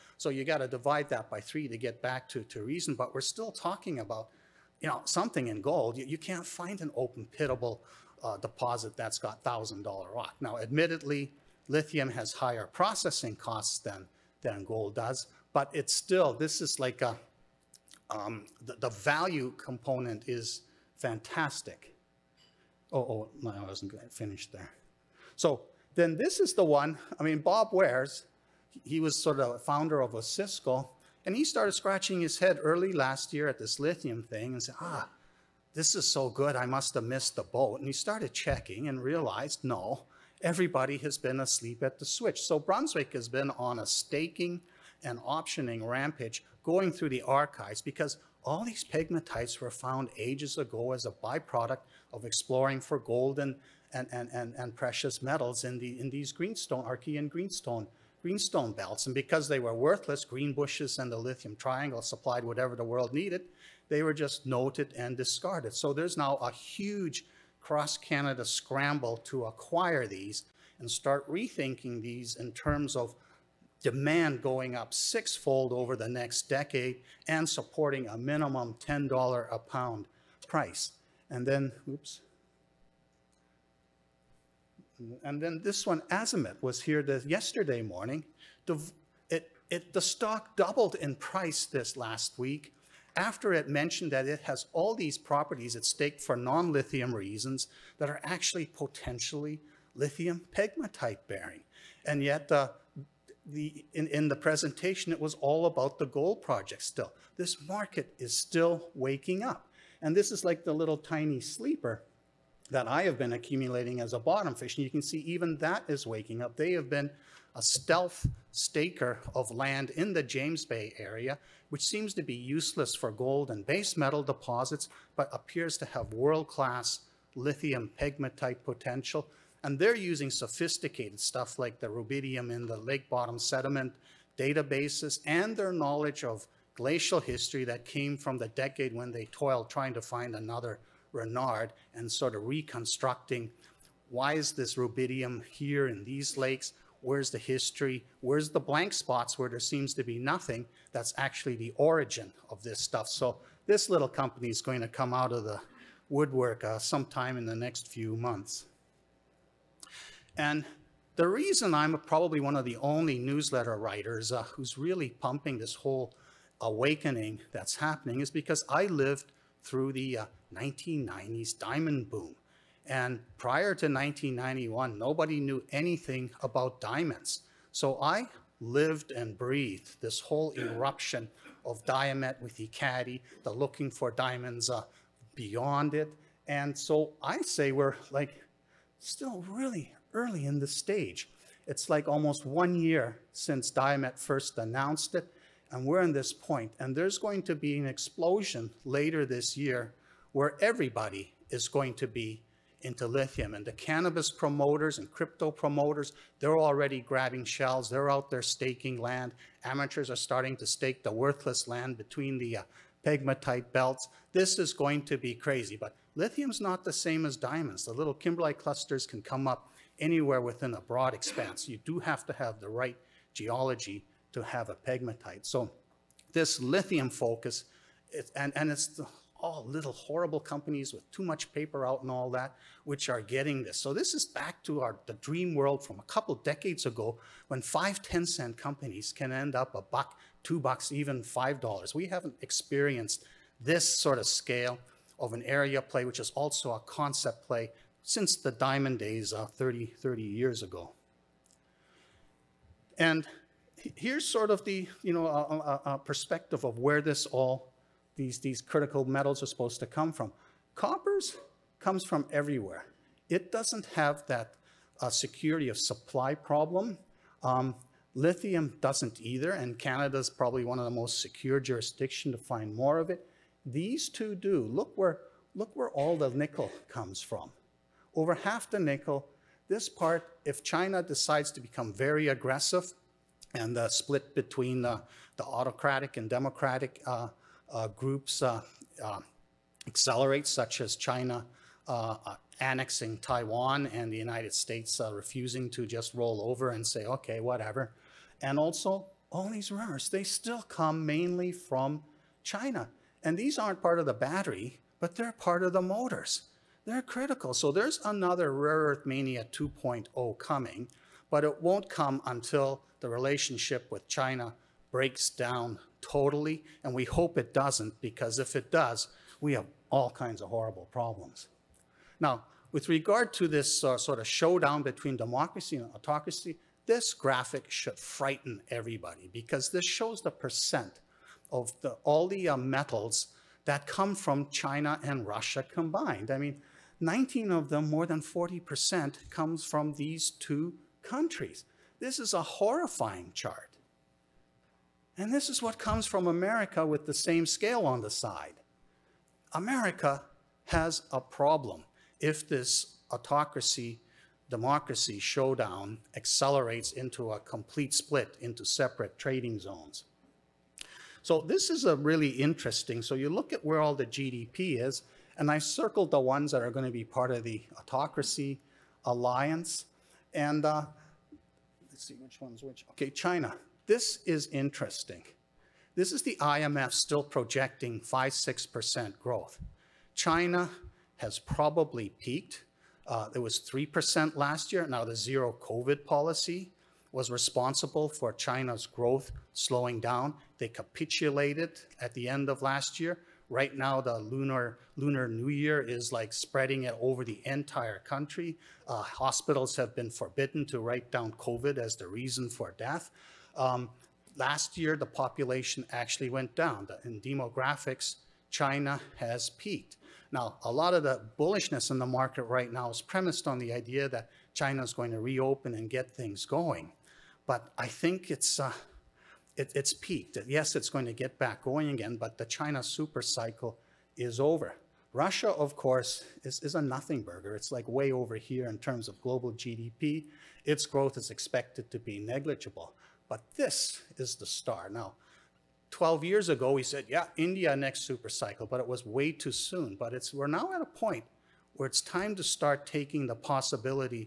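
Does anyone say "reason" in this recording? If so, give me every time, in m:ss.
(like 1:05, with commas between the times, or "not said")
0:02, 1:37, 2:41, 6:42.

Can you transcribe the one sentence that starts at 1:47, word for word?
This market is still waking up.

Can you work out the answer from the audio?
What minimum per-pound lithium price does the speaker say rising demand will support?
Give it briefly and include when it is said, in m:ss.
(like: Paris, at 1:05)
$10 a pound, at 1:18.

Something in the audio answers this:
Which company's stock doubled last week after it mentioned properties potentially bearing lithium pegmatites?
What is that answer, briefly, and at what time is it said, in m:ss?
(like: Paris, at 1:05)
Azimut, at 1:26.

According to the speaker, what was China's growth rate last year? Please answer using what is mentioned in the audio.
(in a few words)
3%.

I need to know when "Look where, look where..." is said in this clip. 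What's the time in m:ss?
4:34.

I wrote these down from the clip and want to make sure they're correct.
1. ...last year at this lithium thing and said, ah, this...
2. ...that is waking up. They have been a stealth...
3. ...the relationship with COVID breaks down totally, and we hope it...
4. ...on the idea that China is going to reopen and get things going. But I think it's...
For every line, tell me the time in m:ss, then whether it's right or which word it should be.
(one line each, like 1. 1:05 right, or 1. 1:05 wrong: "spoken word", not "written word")
1. 0:32 right
2. 1:55 right
3. 5:12 wrong: "China", not "COVID"
4. 6:53 right.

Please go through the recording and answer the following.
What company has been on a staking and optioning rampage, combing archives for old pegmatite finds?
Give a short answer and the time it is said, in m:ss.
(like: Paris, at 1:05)
Brunswick, at 0:42.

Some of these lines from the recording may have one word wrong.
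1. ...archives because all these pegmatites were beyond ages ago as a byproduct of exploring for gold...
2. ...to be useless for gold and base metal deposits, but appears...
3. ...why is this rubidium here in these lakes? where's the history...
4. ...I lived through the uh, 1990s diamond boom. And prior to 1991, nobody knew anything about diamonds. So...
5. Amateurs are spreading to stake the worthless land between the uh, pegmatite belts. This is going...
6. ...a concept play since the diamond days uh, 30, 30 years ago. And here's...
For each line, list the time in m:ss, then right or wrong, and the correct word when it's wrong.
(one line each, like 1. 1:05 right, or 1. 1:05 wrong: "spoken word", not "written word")
1. 0:47 wrong: "found", not "beyond"
2. 2:02 right
3. 2:24 right
4. 2:48 right
5. 3:29 wrong: "starting", not "spreading"
6. 4:06 right.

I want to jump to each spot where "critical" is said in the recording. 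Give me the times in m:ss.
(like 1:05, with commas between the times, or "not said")
4:18, 5:07.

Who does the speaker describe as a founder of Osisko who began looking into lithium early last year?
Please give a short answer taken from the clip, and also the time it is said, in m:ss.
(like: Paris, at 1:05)
Bob Wares, at 0:27.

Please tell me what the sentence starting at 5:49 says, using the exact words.
America has a problem if this autocracy democracy showdown accelerates into a complete split into separate trading zones.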